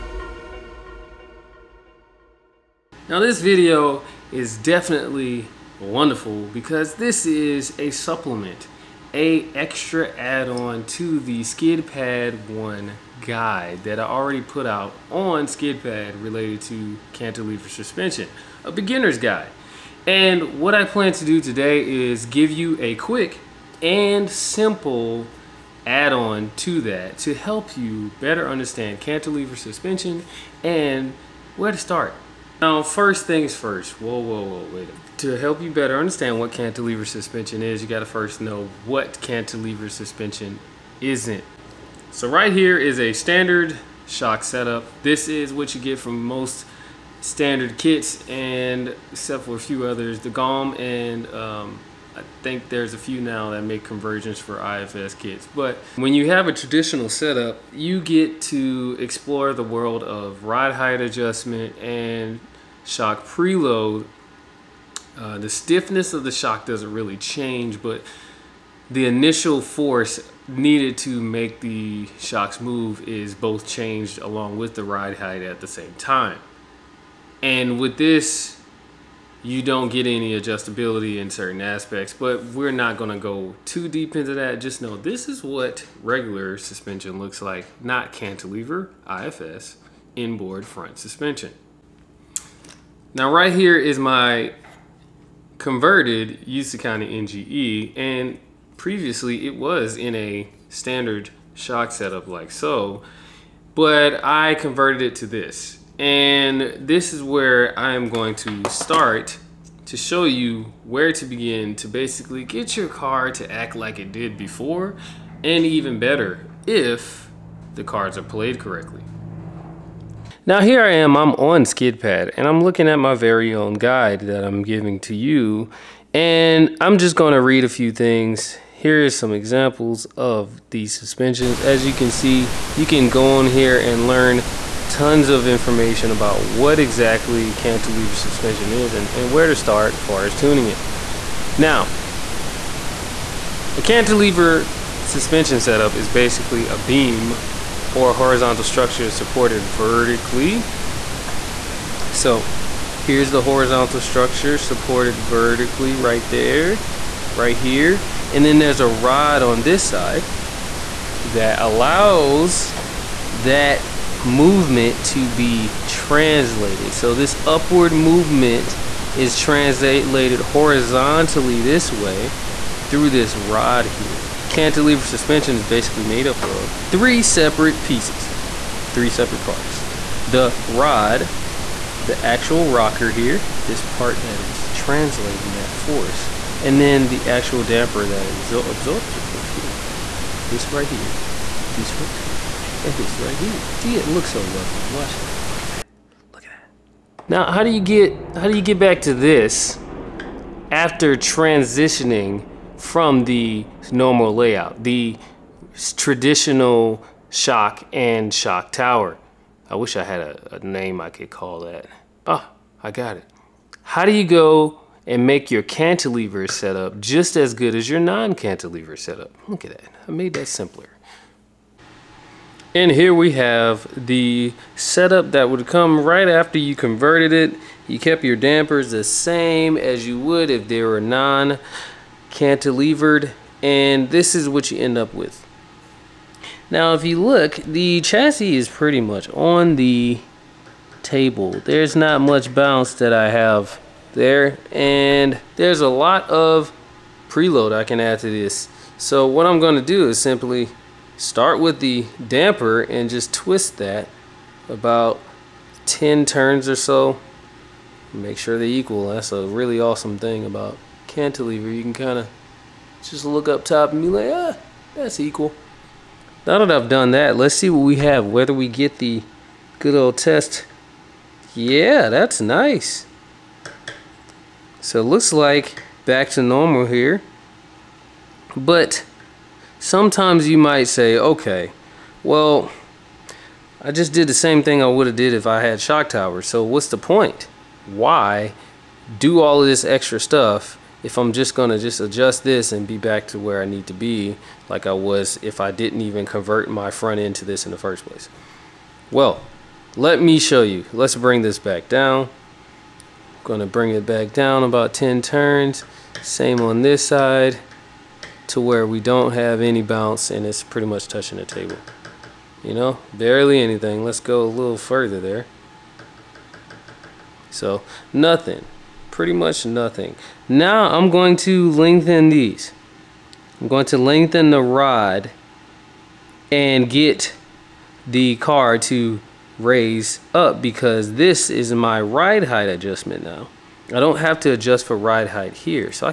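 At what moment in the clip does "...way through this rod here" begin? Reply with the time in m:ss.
2:51.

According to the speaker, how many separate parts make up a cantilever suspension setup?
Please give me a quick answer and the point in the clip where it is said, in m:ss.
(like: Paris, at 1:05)
3, at 2:58.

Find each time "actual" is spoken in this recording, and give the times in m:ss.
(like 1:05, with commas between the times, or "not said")
3:02, 3:07.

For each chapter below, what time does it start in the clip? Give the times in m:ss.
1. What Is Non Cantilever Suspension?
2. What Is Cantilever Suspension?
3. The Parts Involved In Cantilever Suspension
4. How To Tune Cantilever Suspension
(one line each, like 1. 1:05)
1. 0:32
2. 2:00
3. 2:54
4. 3:17.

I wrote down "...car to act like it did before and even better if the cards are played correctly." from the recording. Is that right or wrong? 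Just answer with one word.
right.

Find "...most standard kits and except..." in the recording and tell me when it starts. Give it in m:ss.
0:46.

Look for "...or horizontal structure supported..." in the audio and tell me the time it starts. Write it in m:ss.
2:27.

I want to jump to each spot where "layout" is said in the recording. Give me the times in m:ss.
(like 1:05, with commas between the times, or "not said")
3:24.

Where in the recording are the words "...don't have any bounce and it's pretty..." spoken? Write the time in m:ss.
5:08.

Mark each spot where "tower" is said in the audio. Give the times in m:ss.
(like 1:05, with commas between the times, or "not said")
3:28, 4:46.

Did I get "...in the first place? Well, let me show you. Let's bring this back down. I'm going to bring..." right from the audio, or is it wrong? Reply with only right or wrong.
right.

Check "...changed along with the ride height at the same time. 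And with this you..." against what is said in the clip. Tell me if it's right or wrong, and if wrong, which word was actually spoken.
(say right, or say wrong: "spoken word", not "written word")
right.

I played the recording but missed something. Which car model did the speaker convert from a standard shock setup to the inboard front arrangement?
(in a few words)
Usukani NGE.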